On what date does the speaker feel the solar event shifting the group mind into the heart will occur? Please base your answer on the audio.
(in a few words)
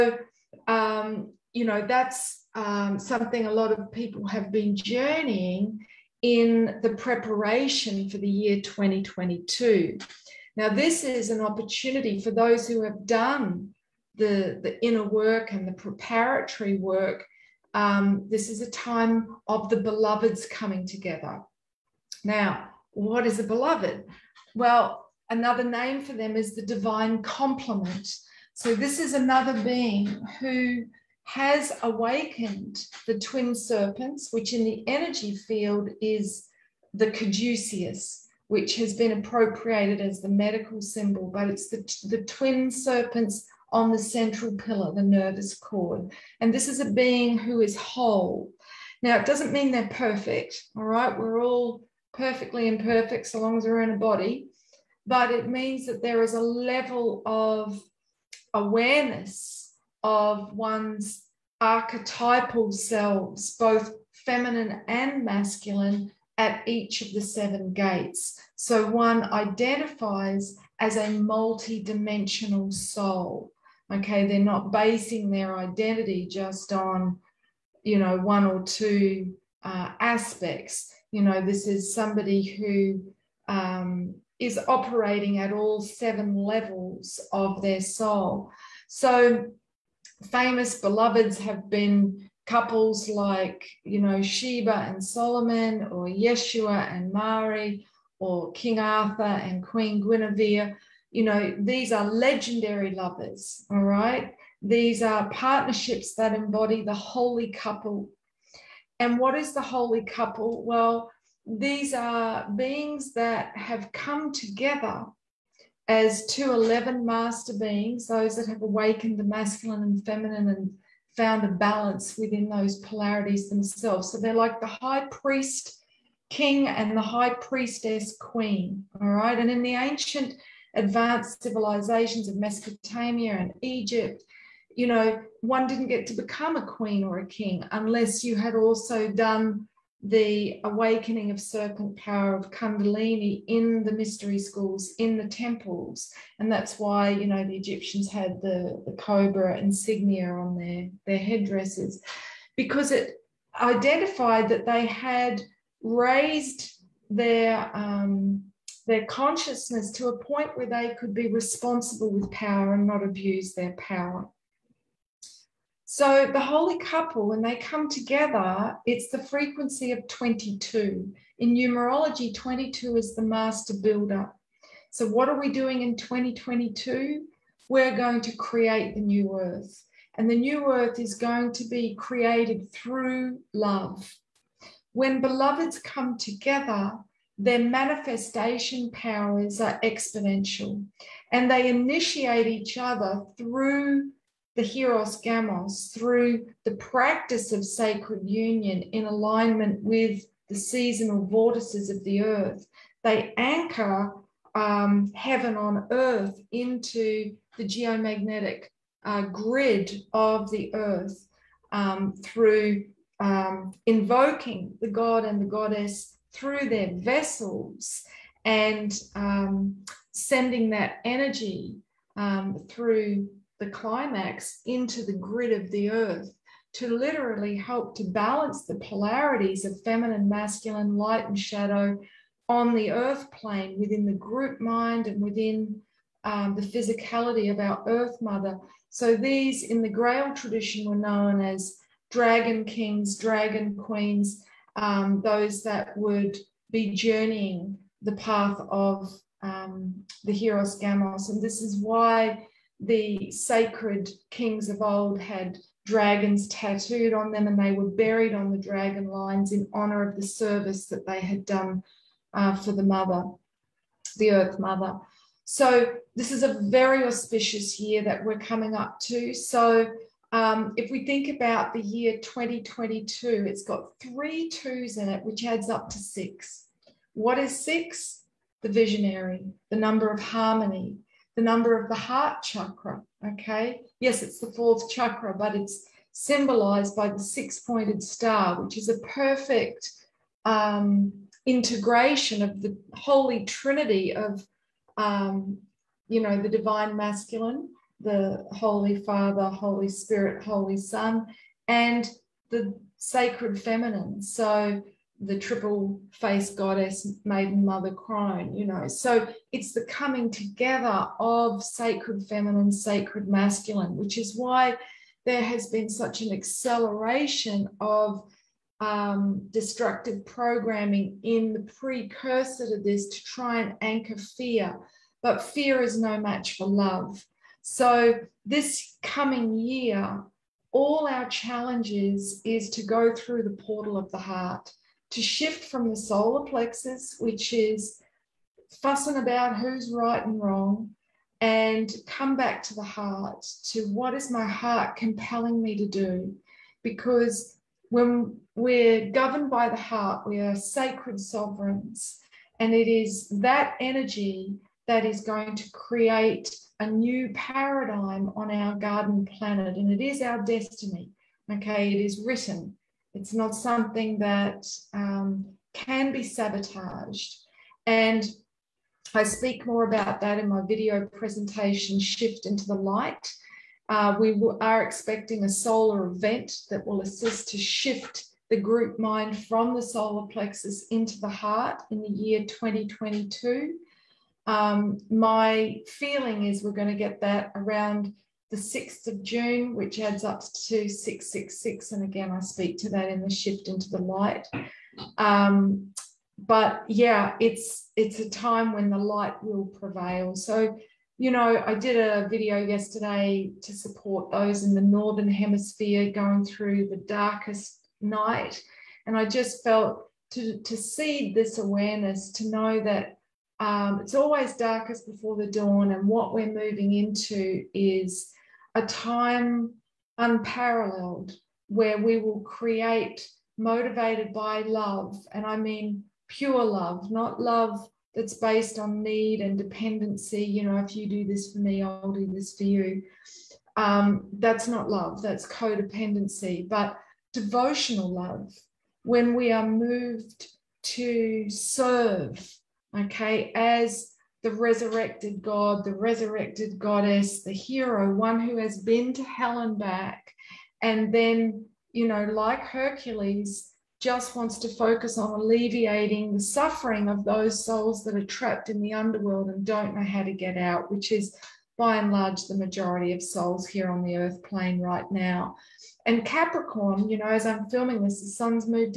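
6th of June.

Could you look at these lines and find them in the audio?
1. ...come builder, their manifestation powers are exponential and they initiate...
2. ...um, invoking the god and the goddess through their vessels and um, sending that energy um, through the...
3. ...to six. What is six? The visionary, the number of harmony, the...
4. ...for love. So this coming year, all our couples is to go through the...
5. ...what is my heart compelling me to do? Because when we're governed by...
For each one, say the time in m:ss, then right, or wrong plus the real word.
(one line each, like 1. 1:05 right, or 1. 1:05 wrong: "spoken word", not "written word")
1. 3:05 wrong: "together", not "builder"
2. 3:33 right
3. 4:35 right
4. 5:26 wrong: "challenges", not "couples"
5. 5:43 right.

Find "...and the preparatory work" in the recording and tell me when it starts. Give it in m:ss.
0:15.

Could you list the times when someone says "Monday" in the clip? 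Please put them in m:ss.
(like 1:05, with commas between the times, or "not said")
not said.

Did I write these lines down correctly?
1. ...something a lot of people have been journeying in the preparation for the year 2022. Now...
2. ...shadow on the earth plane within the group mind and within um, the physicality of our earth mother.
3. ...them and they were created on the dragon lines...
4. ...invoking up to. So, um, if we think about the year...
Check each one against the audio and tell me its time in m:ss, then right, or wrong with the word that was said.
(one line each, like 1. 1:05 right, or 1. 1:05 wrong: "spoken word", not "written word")
1. 0:02 right
2. 3:51 right
3. 4:17 wrong: "buried", not "created"
4. 4:28 wrong: "coming", not "invoking".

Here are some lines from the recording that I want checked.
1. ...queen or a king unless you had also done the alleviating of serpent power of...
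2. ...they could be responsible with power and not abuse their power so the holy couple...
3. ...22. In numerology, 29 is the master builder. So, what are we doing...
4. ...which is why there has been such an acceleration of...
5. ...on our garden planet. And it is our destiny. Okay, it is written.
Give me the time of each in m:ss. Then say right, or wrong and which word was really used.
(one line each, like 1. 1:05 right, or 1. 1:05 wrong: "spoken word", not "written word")
1. 2:16 wrong: "awakening", not "alleviating"
2. 2:40 right
3. 2:50 wrong: "22", not "29"
4. 5:13 right
5. 5:58 right.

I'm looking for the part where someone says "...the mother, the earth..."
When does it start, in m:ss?
4:22.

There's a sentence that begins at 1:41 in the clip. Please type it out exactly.
You know, these are legendary lovers, all right?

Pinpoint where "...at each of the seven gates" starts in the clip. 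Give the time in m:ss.
1:06.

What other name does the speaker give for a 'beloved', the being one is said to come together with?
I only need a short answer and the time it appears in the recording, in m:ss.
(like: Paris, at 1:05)
divine complement, at 0:26.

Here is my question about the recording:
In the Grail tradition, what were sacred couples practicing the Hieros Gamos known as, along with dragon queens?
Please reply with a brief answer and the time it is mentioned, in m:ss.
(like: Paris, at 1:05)
dragon kings, at 4:02.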